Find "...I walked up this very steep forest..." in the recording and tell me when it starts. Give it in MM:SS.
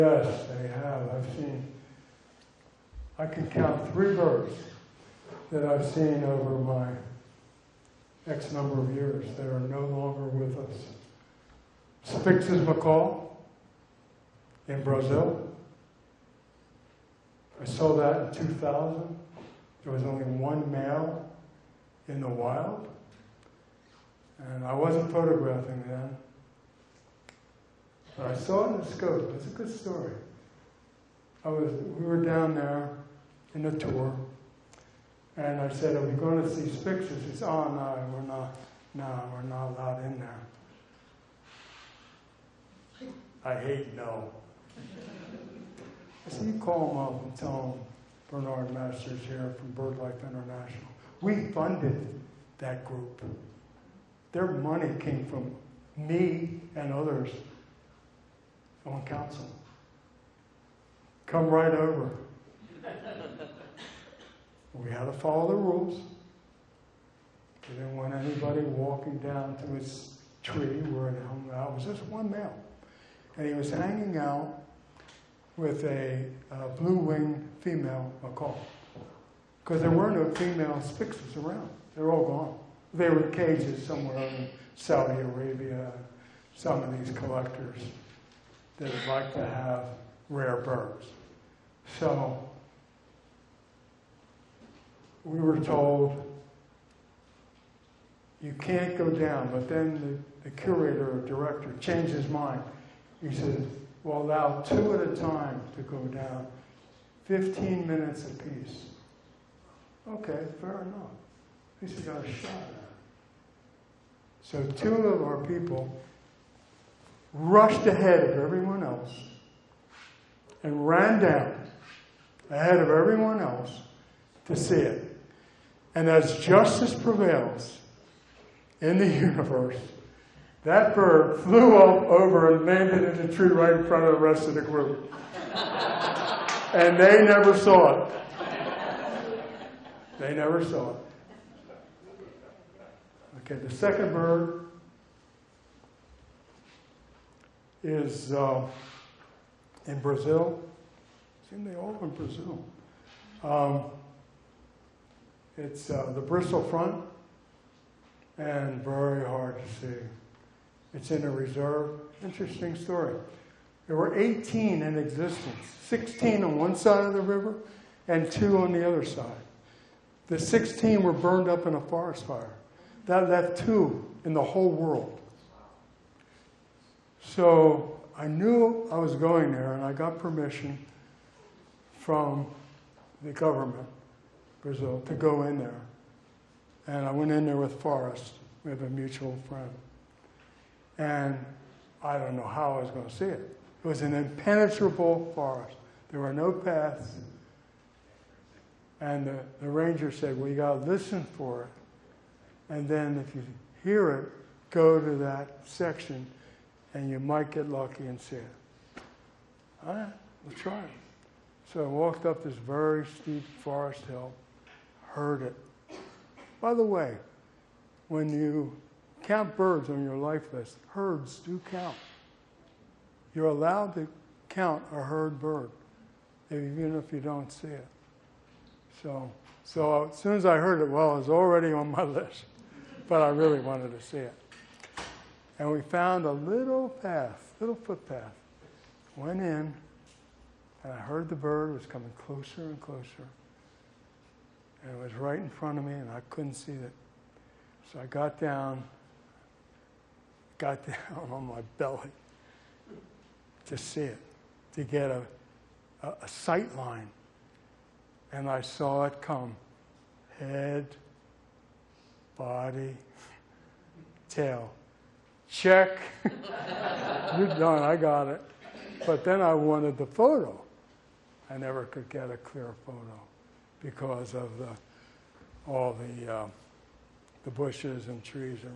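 03:31.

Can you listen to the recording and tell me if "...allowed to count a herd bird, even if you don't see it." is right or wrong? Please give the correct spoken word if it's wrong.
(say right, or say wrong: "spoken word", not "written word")
right.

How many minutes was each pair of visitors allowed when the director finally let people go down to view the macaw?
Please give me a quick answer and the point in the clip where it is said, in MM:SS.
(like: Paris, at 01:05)
15, at 01:47.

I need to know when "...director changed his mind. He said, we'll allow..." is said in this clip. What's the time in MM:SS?
01:41.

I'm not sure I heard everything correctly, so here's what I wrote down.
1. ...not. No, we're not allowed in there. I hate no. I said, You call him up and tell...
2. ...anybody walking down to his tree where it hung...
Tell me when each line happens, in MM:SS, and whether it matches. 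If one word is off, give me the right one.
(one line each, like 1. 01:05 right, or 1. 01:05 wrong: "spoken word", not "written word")
1. 00:38 right
2. 01:08 right.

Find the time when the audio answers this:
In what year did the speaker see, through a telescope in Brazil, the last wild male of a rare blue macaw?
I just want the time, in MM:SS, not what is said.
00:18.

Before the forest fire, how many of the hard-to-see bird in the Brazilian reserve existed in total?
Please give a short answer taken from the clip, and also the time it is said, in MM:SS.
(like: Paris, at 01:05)
18, at 02:44.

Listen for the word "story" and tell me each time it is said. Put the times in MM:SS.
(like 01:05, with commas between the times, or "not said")
00:29, 02:42.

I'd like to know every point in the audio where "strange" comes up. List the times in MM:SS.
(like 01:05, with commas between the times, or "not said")
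not said.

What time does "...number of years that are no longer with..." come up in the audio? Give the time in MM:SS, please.
00:08.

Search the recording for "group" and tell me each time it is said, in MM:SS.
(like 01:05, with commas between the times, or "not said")
00:52, 02:14.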